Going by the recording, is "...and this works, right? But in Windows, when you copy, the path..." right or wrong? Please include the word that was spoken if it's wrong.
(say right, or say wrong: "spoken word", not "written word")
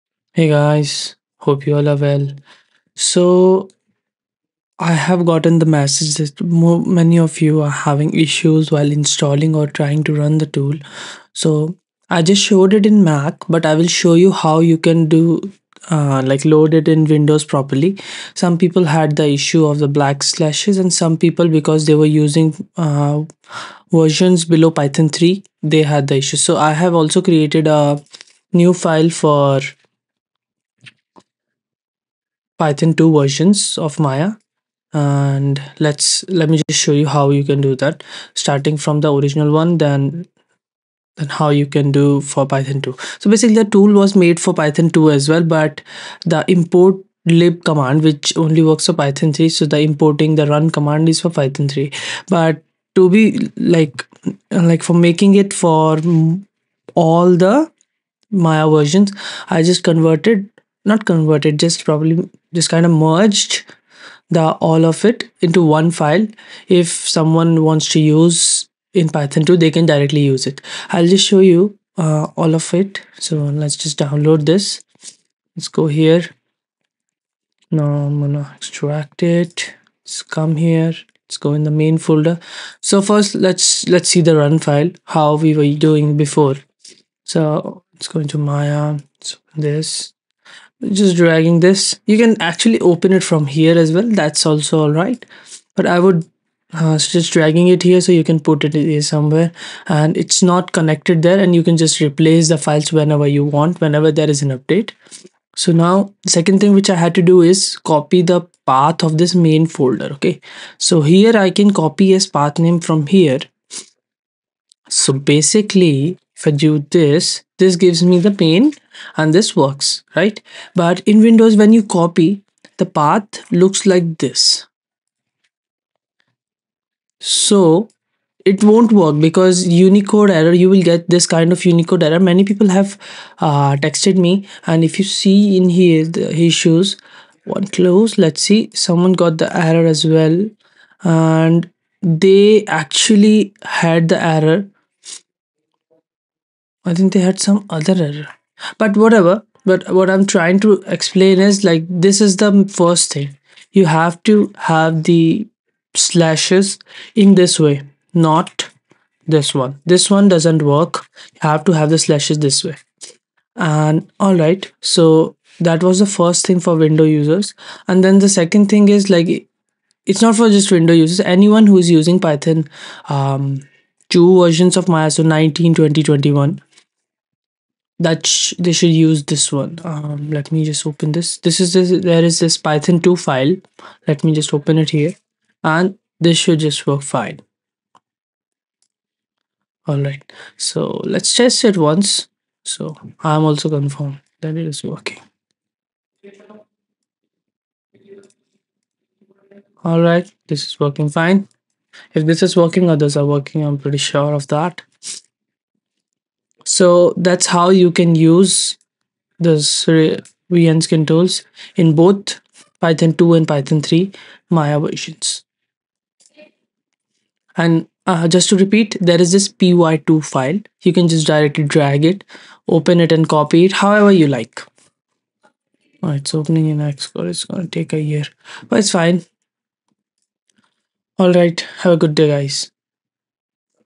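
right.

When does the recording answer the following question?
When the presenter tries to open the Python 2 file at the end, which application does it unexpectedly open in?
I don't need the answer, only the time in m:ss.
3:46.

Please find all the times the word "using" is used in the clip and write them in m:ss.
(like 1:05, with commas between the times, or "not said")
0:22, 2:51.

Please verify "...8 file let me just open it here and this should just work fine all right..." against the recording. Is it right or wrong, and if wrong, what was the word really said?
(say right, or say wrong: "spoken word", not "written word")
wrong: "2", not "8".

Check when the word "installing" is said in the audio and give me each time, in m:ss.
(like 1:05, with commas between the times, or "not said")
0:08.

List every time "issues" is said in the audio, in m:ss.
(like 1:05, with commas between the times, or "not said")
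0:08, 0:19, 0:26, 2:16.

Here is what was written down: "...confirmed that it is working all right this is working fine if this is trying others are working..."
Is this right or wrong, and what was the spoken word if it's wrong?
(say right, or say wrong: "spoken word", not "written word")
wrong: "working", not "trying".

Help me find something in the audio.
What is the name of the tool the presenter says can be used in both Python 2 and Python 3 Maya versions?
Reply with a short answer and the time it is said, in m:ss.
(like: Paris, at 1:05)
VN skin tools, at 3:30.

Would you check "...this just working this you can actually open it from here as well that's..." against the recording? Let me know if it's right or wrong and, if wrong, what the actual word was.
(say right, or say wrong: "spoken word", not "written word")
wrong: "dragging", not "working".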